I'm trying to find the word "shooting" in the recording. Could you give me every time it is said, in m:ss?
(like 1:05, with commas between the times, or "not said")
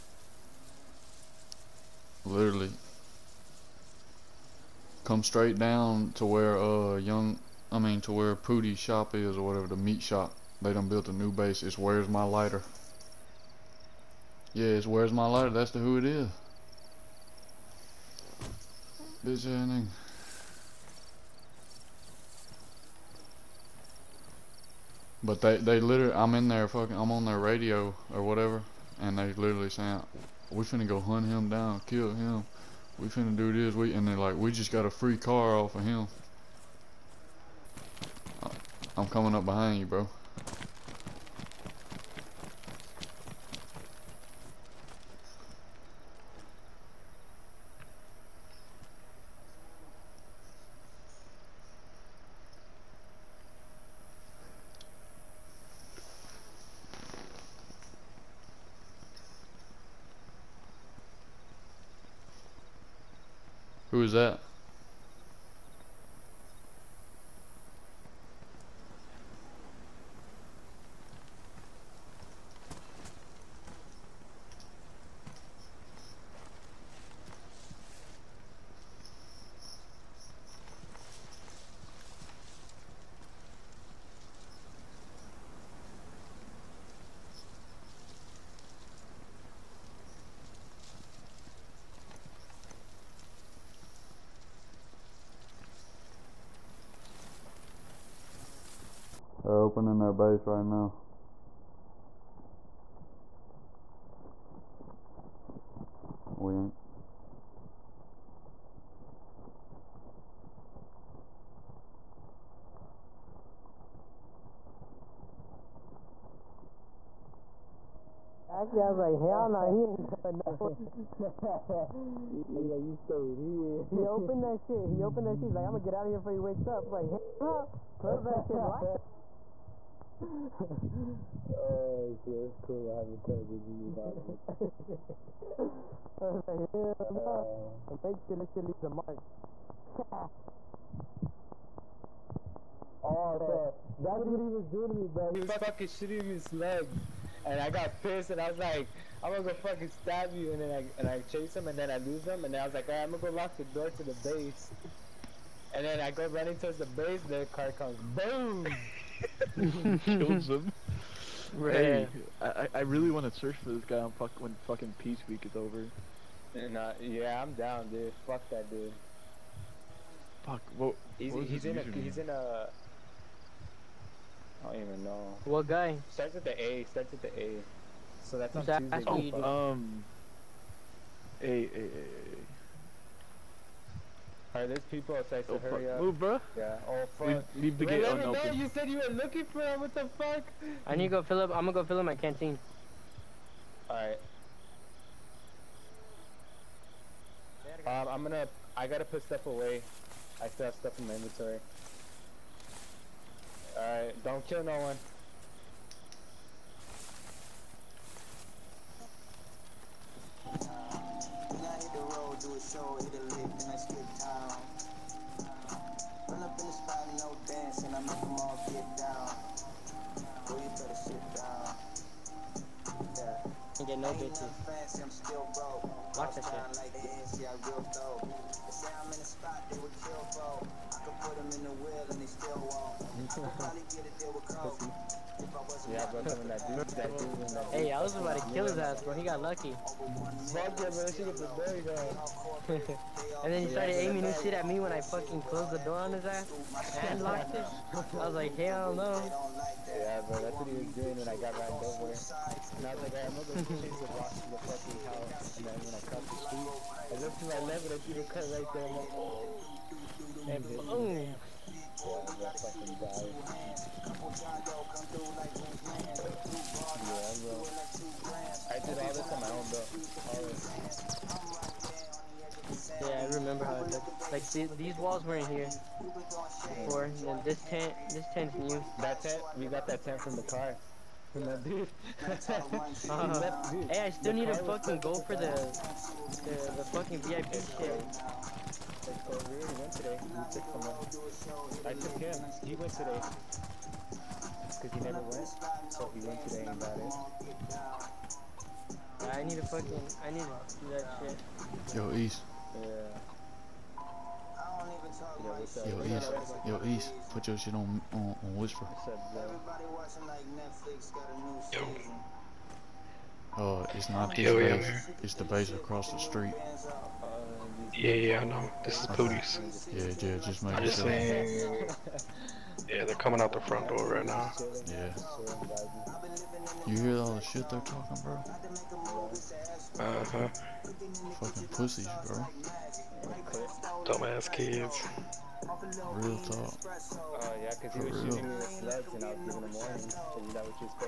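2:25, 5:38.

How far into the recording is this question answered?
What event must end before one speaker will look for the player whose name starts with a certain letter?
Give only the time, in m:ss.
2:44.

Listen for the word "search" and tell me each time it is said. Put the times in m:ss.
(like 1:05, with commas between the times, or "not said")
2:43.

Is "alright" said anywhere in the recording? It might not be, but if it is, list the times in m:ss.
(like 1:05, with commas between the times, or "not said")
2:32, 3:04, 3:13, 3:23.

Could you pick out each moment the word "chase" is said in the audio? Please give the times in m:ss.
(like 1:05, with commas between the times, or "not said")
2:31, 4:13.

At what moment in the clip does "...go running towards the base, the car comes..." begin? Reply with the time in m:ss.
2:36.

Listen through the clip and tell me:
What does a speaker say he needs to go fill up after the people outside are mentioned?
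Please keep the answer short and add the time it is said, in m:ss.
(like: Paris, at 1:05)
canteen, at 3:12.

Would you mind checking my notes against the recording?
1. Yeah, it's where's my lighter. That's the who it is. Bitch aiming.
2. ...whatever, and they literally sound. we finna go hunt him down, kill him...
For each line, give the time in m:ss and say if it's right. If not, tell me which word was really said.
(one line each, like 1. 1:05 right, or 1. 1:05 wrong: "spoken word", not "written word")
1. 0:14 wrong: "ending", not "aiming"
2. 0:28 right.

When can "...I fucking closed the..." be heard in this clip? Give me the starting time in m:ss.
4:04.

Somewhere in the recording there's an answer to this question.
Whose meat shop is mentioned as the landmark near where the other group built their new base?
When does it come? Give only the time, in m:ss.
0:08.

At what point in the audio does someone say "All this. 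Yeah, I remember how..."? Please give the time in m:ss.
4:30.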